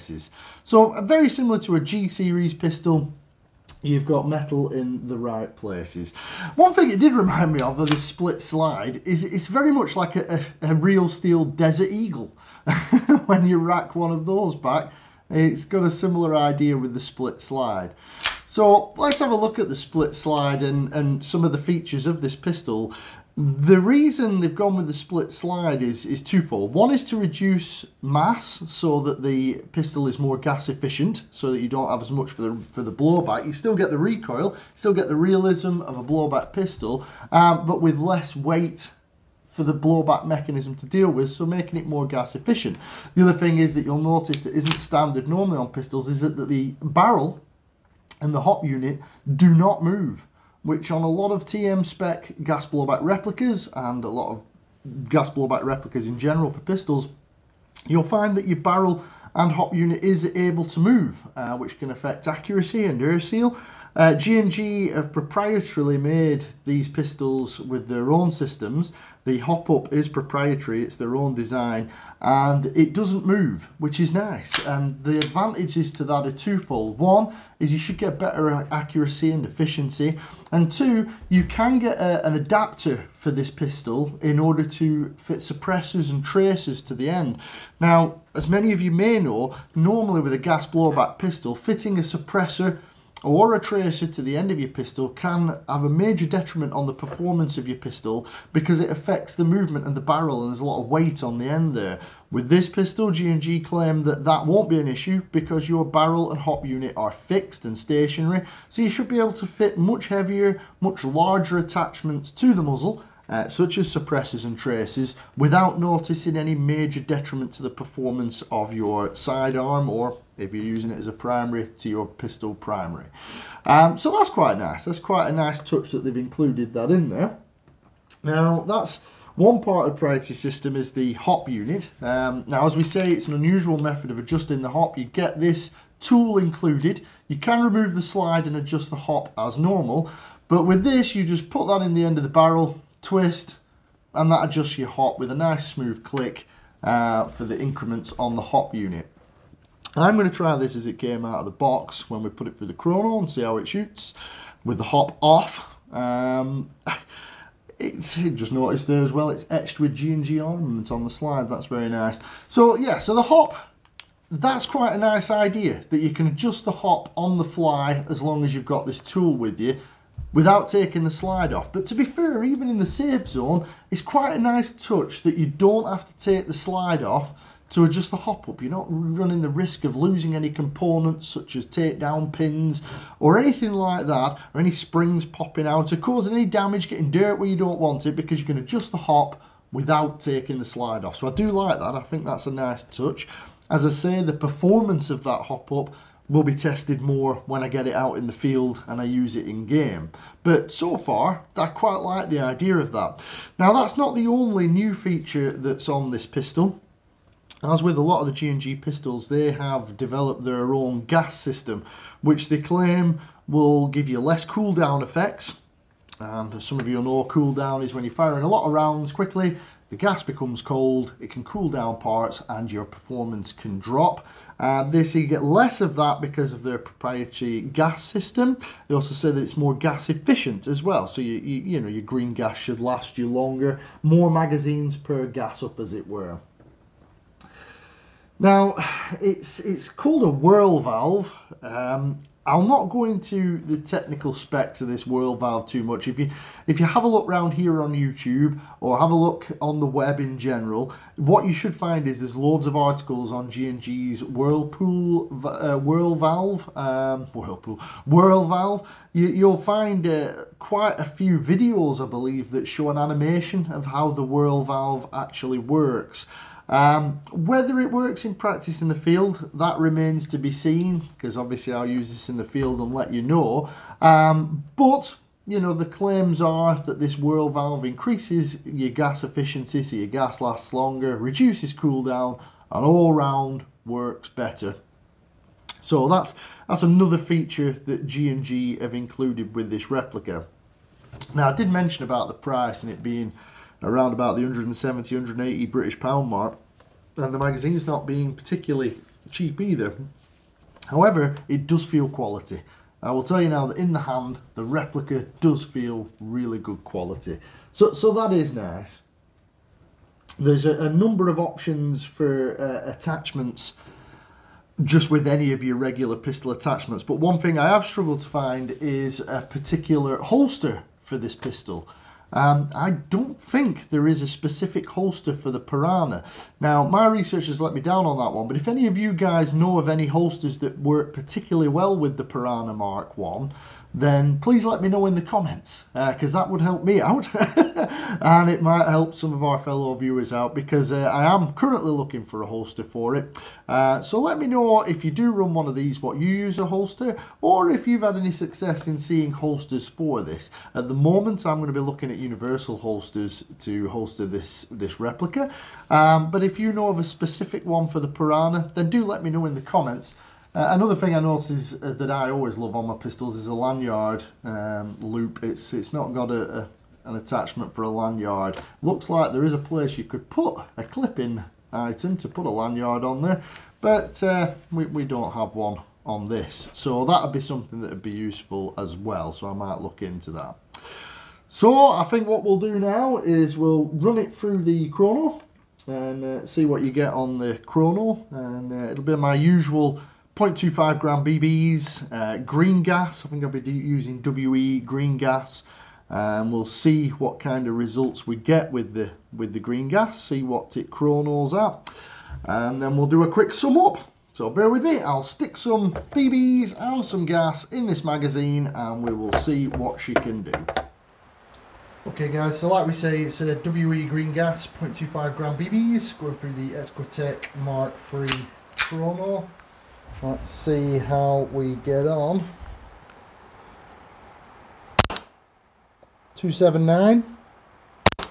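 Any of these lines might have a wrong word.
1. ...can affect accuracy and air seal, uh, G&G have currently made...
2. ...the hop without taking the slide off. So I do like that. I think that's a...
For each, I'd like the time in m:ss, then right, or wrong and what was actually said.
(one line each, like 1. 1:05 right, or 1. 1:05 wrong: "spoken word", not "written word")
1. 1:01 wrong: "proprietarily", not "currently"
2. 3:08 right.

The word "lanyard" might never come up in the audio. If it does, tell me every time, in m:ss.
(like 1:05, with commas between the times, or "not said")
6:03, 6:07, 6:12.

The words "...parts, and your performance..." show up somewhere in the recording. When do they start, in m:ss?
3:41.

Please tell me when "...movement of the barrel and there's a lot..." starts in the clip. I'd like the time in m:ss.
1:39.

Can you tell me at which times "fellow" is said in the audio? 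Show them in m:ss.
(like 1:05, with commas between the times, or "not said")
5:39.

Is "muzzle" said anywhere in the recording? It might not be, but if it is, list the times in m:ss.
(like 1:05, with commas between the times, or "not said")
1:52.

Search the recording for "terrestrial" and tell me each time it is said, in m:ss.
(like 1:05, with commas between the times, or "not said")
not said.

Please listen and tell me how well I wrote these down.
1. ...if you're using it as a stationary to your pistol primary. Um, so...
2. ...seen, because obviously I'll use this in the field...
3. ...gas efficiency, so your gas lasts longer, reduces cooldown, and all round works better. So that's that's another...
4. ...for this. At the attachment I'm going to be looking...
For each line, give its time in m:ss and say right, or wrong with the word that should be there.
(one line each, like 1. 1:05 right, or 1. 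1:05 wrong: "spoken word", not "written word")
1. 2:00 wrong: "primary", not "stationary"
2. 4:30 right
3. 4:38 right
4. 5:49 wrong: "moment", not "attachment".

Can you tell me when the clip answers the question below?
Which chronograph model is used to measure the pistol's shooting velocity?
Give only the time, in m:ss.
6:56.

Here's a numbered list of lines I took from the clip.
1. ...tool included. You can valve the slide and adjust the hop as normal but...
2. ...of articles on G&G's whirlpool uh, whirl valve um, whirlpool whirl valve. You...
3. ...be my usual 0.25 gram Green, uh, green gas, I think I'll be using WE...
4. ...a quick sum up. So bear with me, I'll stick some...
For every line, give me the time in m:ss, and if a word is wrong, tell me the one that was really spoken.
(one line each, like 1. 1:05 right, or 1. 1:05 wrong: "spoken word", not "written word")
1. 2:15 wrong: "remove", not "valve"
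2. 4:12 right
3. 6:29 wrong: "BBs", not "Green"
4. 6:43 right.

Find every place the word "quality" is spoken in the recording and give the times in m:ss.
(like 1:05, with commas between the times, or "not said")
5:02, 5:06.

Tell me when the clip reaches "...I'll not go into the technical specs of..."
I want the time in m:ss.
4:02.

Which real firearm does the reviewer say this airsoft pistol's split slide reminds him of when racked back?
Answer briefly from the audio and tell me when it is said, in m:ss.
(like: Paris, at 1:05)
Desert Eagle, at 0:11.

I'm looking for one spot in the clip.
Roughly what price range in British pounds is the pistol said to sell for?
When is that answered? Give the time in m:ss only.
4:54.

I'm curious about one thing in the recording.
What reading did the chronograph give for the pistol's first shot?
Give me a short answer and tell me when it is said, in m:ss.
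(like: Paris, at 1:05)
279, at 7:06.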